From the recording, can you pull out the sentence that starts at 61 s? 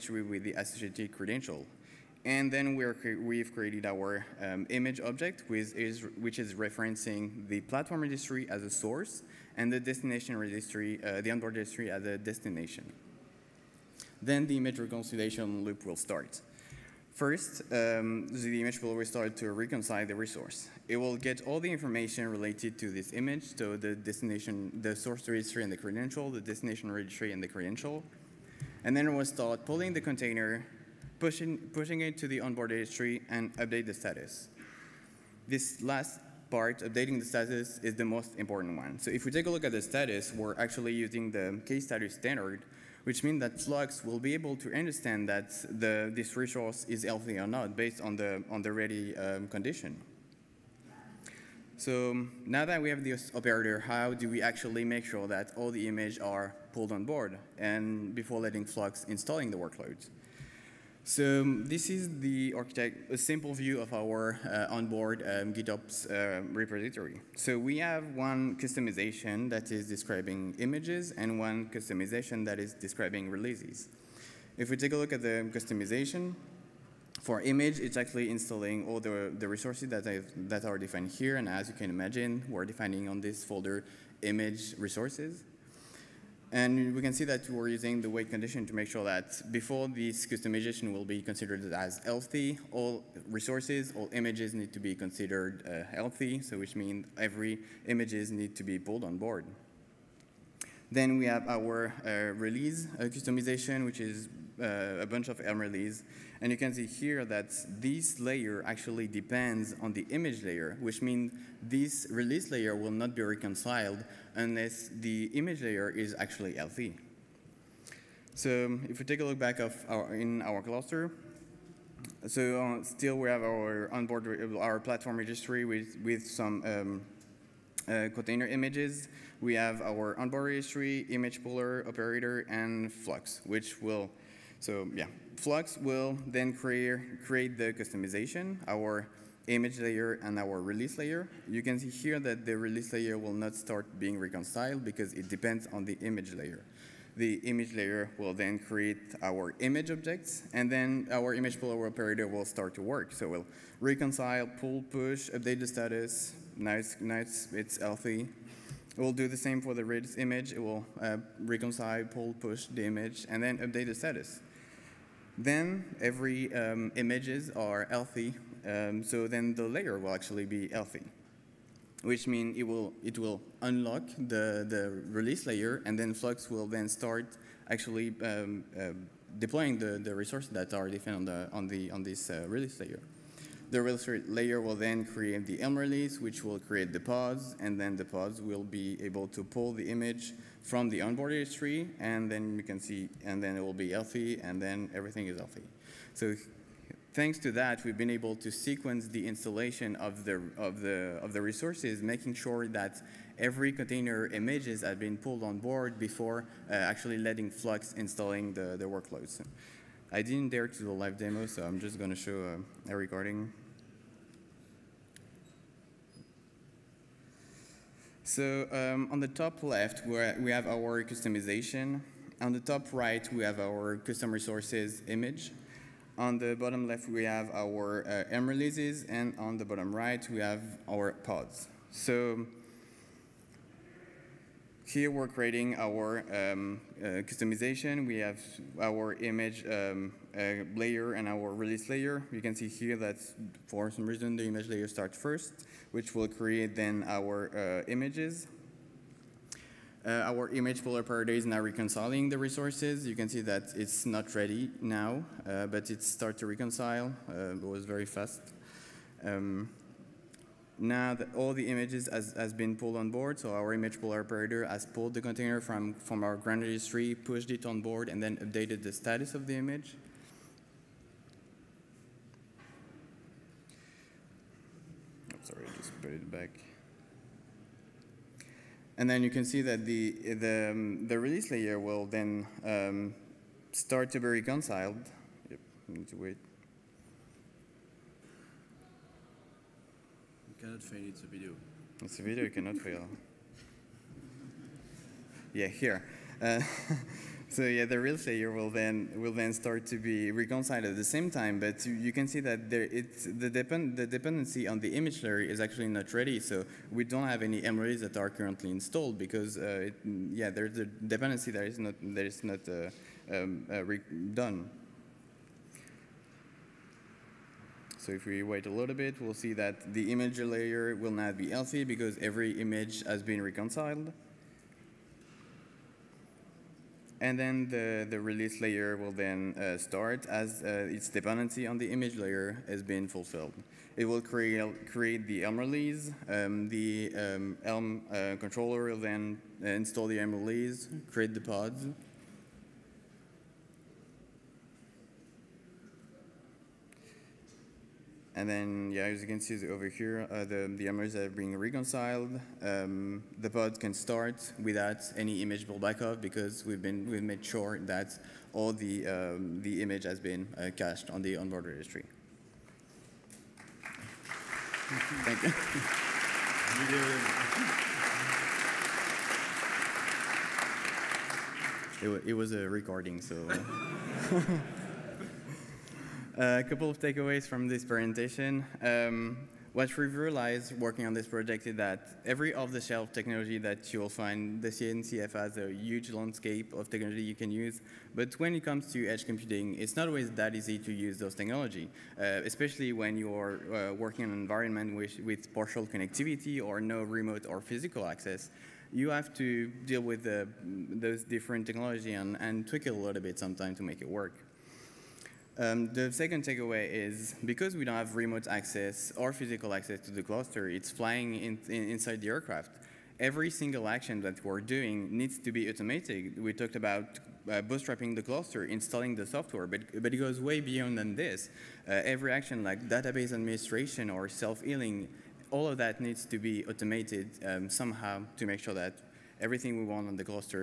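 So um, this is the architect, a simple view of our uh, onboard um, GitOps uh, repository.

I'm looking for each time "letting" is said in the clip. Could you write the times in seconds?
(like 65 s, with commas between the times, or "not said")
58 s, 207 s.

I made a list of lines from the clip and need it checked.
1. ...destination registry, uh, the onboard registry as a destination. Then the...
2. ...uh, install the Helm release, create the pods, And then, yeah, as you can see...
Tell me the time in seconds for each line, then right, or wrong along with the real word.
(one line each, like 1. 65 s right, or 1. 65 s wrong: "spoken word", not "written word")
1. 9 s right
2. 339 s right.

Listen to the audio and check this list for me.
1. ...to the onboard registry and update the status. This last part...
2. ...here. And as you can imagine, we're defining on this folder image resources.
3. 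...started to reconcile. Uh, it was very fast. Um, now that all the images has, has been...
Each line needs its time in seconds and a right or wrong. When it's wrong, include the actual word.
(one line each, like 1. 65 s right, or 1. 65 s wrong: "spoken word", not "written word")
1. 32 s right
2. 81 s right
3. 256 s right.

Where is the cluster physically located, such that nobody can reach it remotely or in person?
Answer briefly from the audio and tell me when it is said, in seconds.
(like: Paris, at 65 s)
inside the aircraft, at 411 s.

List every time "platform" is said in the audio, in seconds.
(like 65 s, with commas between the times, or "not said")
7 s, 124 s.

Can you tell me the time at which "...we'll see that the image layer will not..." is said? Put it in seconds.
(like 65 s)
319 s.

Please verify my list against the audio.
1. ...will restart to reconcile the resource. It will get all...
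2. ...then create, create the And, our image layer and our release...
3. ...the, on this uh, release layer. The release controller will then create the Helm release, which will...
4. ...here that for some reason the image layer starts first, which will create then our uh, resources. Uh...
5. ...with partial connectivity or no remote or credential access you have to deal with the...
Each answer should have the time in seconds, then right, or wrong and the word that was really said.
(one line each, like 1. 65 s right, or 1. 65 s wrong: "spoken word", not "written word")
1. 18 s right
2. 136 s wrong: "Kustomization", not "And"
3. 181 s wrong: "layer", not "controller"
4. 242 s wrong: "images", not "resources"
5. 395 s wrong: "physical", not "credential".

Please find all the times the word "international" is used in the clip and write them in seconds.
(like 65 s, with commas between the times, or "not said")
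not said.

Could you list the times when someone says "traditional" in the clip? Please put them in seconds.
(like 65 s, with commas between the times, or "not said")
not said.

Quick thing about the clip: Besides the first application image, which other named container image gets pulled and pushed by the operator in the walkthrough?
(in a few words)
Redis.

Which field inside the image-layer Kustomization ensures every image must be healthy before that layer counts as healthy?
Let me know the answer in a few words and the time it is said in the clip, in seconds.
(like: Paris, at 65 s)
wait condition, at 88 s.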